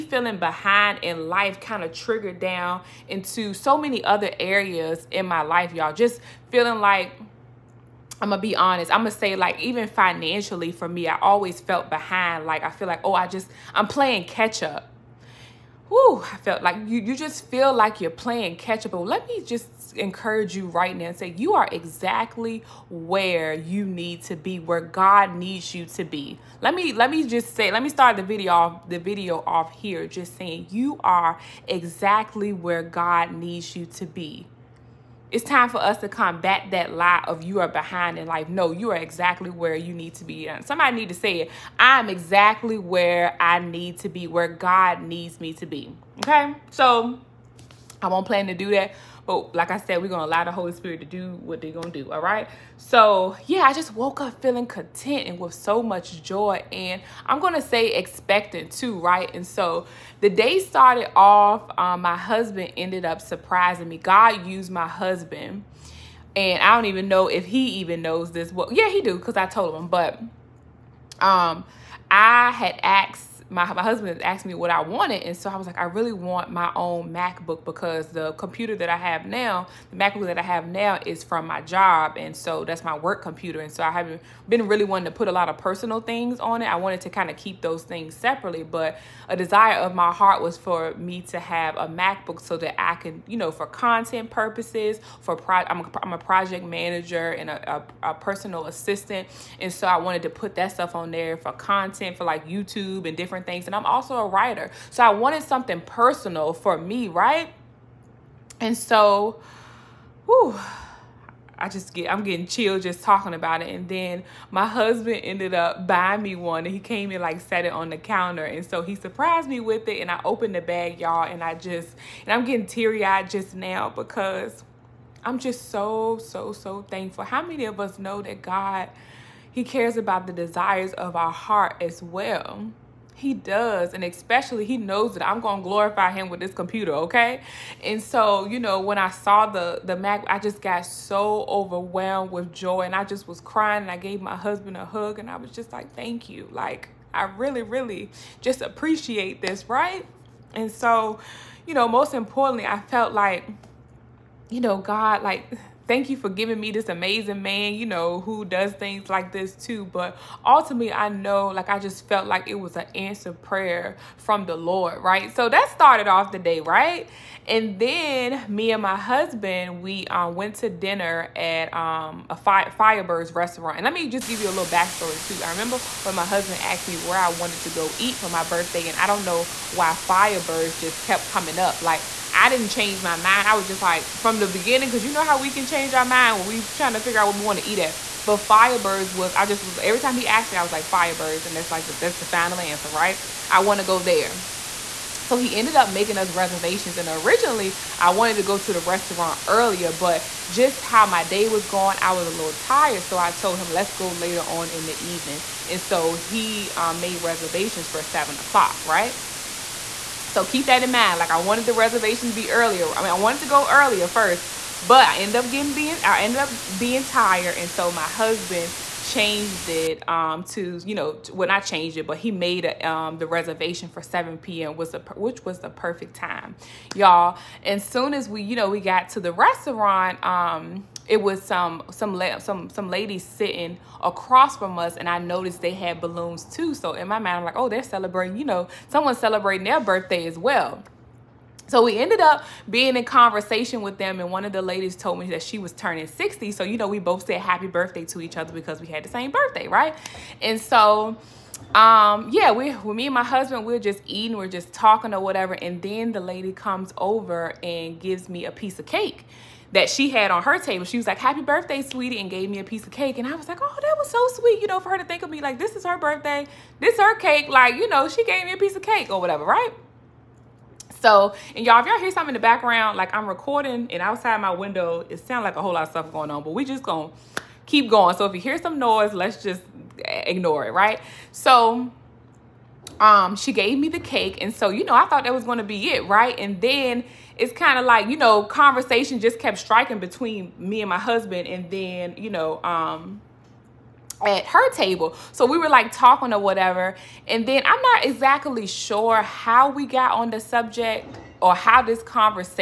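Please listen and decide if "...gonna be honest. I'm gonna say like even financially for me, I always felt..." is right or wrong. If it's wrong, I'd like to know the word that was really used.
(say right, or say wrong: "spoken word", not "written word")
right.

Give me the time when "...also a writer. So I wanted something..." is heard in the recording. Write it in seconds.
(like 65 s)
103 s.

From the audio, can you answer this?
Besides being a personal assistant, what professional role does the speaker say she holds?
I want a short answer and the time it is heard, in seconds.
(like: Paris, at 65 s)
Project manager, at 96 s.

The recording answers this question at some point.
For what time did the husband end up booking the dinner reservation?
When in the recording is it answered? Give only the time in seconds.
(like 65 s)
224 s.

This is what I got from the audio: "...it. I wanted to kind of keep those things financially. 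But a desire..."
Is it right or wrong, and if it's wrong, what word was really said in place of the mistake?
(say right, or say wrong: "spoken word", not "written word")
wrong: "separately", not "financially".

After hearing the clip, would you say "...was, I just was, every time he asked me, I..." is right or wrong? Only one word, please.
right.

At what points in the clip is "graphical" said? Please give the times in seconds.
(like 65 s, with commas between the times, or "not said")
not said.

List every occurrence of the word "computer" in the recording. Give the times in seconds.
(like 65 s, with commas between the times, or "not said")
78 s, 83 s, 136 s.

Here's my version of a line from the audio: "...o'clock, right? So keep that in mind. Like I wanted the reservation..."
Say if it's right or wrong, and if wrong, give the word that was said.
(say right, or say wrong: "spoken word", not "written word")
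right.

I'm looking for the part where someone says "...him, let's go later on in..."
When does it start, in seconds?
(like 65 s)
203 s.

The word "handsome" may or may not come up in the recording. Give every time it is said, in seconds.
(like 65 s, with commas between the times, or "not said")
not said.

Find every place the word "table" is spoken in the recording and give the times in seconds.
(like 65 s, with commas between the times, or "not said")
260 s, 294 s.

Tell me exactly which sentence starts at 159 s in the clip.
But ultimately, I know, like, I just felt like it was an answered prayer from the Lord, right?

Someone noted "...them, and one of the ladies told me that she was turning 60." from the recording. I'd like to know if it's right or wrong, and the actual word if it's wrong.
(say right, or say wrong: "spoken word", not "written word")
right.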